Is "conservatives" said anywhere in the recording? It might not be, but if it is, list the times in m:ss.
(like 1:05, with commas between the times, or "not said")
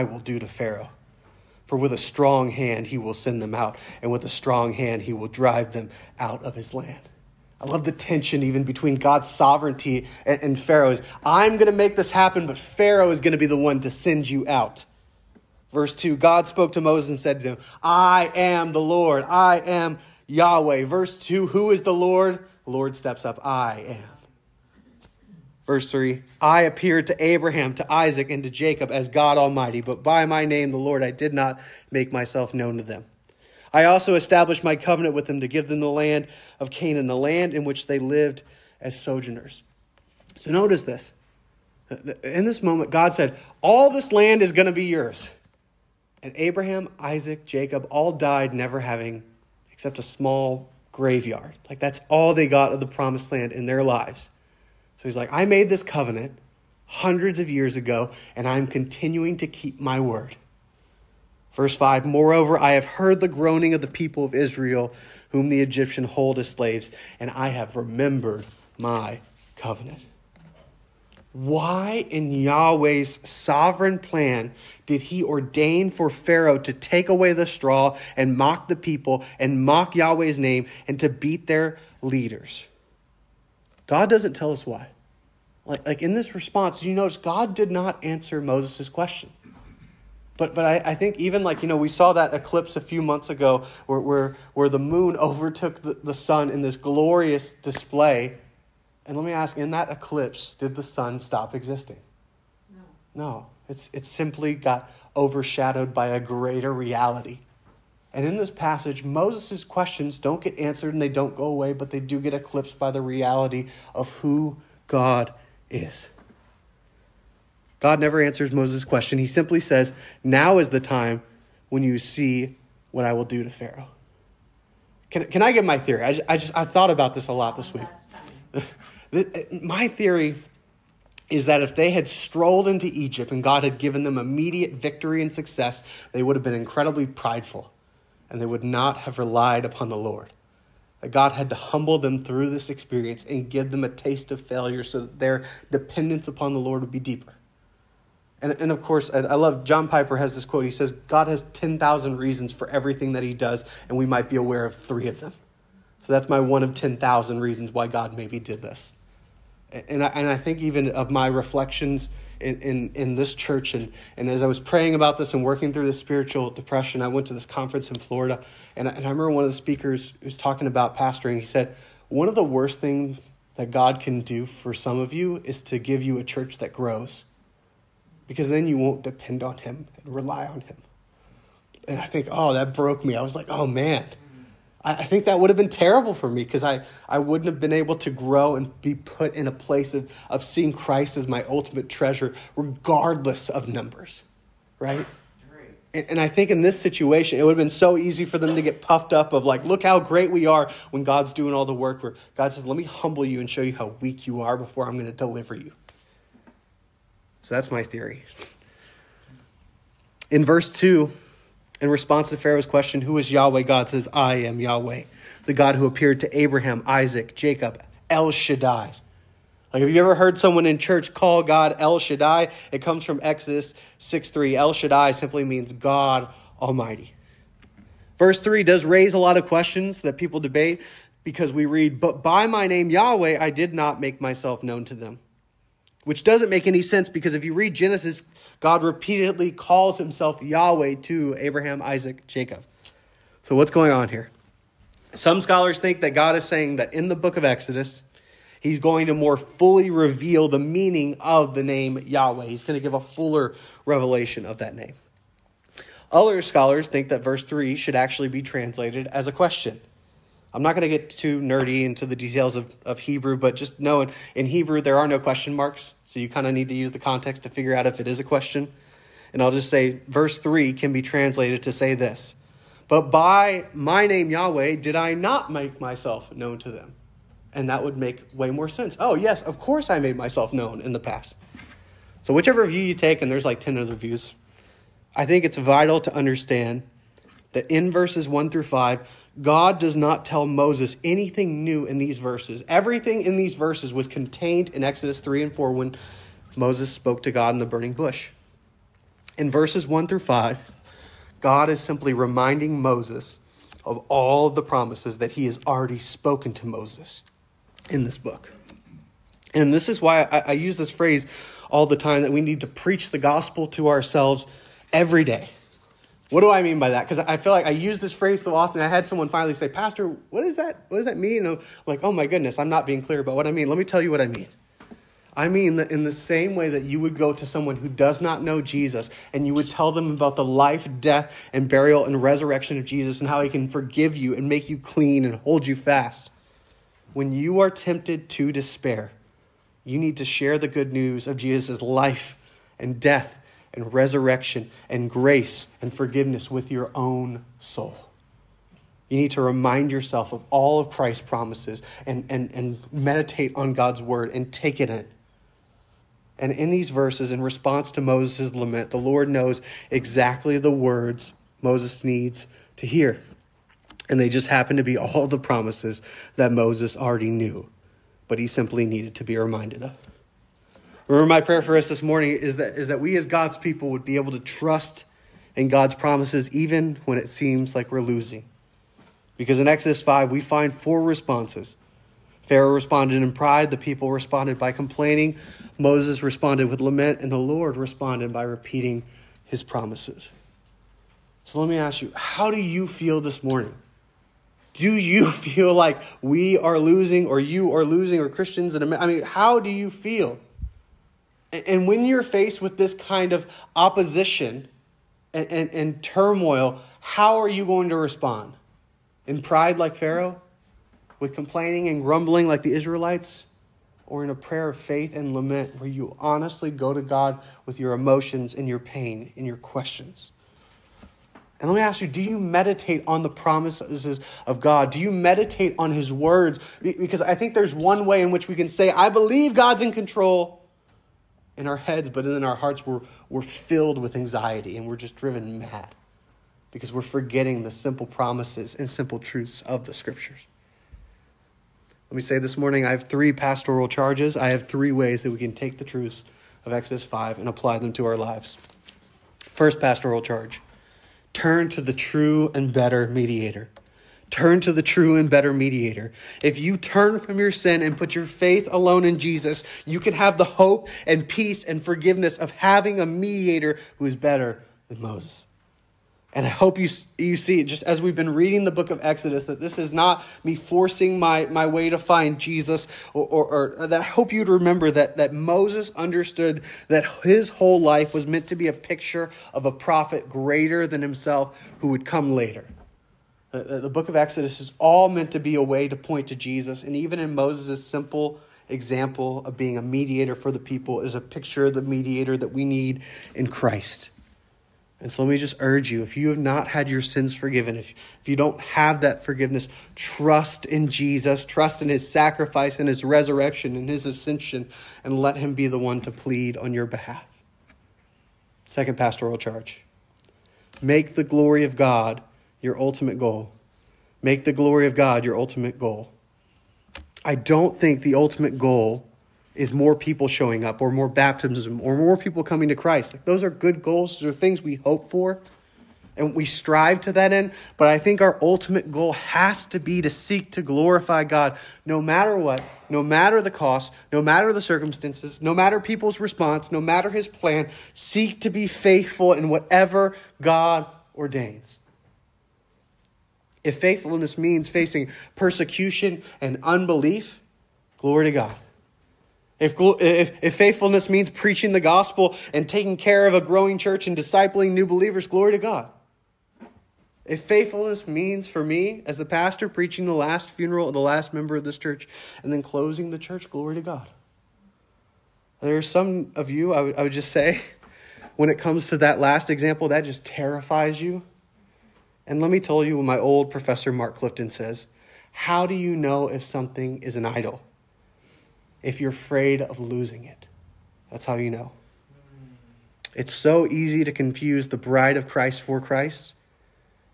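not said.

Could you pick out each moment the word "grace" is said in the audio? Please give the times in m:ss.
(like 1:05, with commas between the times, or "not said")
5:45.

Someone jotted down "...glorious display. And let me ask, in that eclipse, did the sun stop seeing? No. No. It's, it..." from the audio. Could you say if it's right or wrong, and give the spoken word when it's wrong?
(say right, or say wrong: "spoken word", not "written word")
wrong: "existing", not "seeing".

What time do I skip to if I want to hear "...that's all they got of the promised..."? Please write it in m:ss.
0:51.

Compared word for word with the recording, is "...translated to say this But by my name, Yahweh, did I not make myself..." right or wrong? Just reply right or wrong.
right.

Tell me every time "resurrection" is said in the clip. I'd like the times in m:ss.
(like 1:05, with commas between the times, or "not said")
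5:32, 5:43, 8:23.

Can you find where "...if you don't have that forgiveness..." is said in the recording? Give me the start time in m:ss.
8:18.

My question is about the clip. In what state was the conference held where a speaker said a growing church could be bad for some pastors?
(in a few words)
Florida.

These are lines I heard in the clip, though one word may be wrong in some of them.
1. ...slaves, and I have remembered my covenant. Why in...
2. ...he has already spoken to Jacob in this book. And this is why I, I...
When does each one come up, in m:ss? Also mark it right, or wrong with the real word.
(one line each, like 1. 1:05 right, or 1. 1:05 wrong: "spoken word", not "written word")
1. 1:06 right
2. 5:05 wrong: "Moses", not "Jacob".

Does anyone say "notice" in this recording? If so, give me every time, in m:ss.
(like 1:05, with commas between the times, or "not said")
0:40, 1:26.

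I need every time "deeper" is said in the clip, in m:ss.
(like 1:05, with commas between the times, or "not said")
2:26.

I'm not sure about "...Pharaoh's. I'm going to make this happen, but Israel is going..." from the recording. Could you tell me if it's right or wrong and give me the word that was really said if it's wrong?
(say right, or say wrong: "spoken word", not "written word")
wrong: "Pharaoh", not "Israel".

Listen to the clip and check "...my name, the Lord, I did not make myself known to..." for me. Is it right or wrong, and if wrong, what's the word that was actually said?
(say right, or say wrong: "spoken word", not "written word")
right.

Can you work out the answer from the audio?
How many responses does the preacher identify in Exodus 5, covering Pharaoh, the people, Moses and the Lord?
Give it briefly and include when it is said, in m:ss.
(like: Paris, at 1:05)
4, at 6:20.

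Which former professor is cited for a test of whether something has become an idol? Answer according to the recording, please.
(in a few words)
Mark Clifton.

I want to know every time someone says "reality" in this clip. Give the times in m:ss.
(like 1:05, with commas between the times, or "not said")
1:46, 1:53.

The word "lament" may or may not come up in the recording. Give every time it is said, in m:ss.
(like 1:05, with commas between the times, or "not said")
5:58, 6:26, 6:55.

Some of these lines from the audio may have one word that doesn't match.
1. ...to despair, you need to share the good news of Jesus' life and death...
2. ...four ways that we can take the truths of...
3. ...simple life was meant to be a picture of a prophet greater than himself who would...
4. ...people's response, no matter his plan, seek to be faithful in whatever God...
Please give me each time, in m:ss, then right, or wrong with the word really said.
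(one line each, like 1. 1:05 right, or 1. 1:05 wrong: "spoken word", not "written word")
1. 5:38 right
2. 7:24 wrong: "three", not "four"
3. 7:57 wrong: "whole", not "simple"
4. 8:55 right.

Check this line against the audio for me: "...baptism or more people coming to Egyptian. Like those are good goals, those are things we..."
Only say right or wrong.
wrong.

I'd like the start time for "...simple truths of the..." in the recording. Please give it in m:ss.
7:18.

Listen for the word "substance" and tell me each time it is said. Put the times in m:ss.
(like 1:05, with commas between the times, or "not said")
not said.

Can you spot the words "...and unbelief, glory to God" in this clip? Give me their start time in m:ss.
9:06.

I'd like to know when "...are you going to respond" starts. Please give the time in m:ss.
6:47.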